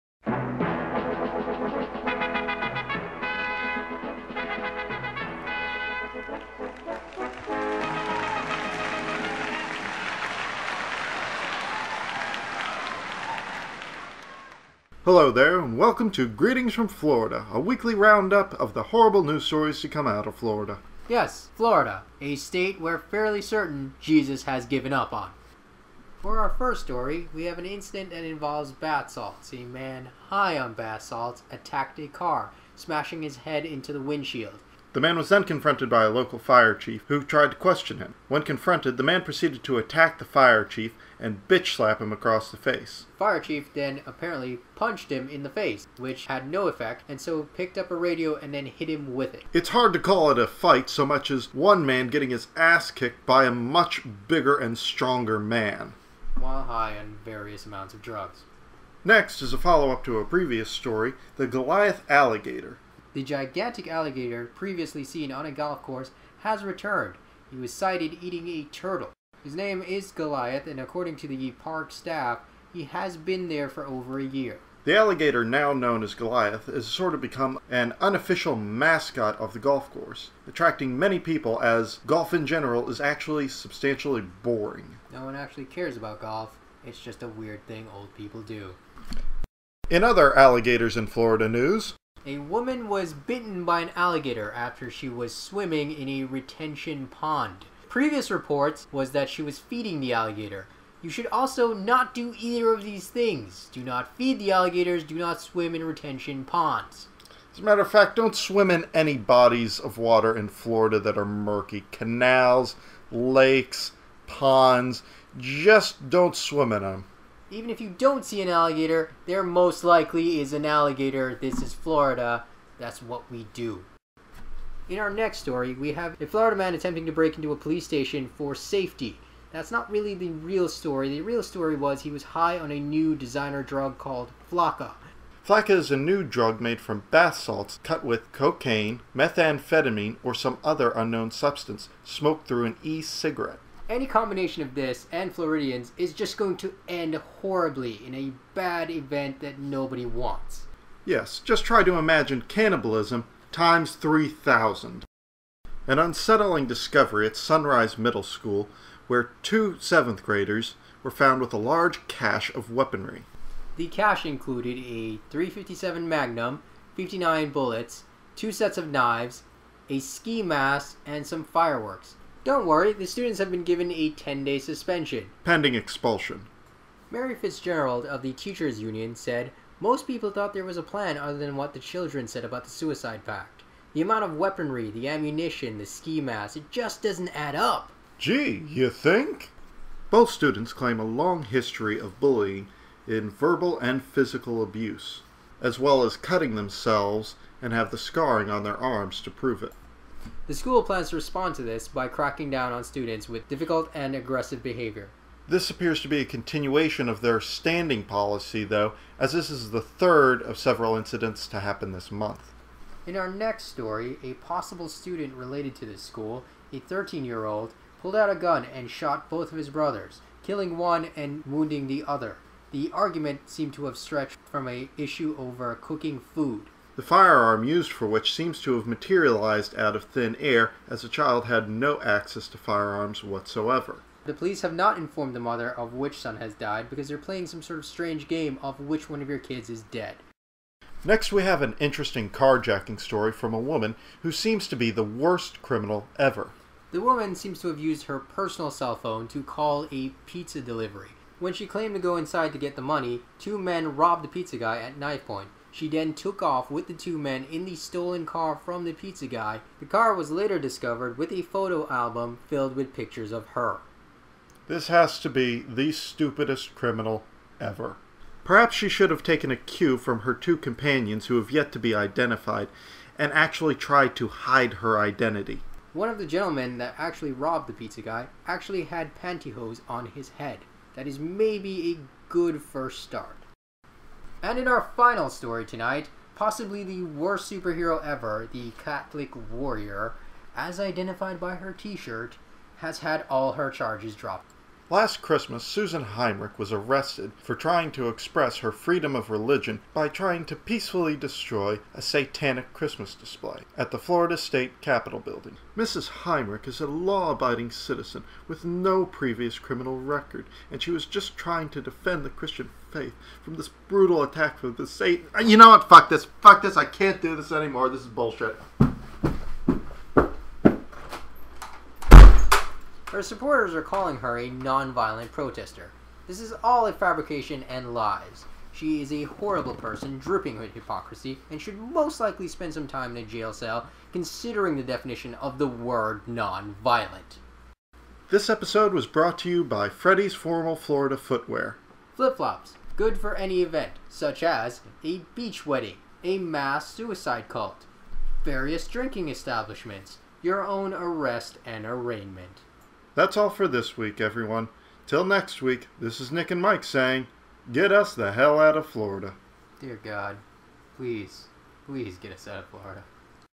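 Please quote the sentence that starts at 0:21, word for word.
Yes, Florida, a state we're fairly certain Jesus has given up on.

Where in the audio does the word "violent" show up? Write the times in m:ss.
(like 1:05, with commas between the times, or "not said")
5:24, 5:36.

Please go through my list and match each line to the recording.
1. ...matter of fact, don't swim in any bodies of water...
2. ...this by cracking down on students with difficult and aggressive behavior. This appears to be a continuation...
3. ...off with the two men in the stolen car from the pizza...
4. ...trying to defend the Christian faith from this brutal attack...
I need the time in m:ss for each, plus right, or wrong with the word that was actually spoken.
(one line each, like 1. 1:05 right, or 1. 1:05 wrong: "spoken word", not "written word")
1. 1:47 right
2. 3:21 right
3. 4:16 right
4. 5:11 right.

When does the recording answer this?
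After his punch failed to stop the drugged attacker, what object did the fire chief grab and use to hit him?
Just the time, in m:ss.
0:47.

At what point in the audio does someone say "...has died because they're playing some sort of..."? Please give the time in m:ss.
3:56.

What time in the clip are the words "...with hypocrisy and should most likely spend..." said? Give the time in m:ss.
5:30.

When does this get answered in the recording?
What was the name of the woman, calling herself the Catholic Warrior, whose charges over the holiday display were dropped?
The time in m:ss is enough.
4:55.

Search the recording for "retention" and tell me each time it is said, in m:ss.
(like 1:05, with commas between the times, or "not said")
1:36, 1:45.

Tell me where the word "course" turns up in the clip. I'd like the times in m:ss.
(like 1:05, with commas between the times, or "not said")
1:05, 1:19.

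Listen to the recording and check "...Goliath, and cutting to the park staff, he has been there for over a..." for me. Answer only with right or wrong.
wrong.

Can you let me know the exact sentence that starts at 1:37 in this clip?
Previous reports was that she was feeding the alligator.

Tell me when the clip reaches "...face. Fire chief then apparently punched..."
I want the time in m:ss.
0:42.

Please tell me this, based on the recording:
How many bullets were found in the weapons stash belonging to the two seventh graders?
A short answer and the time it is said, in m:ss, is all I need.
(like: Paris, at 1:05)
59, at 2:46.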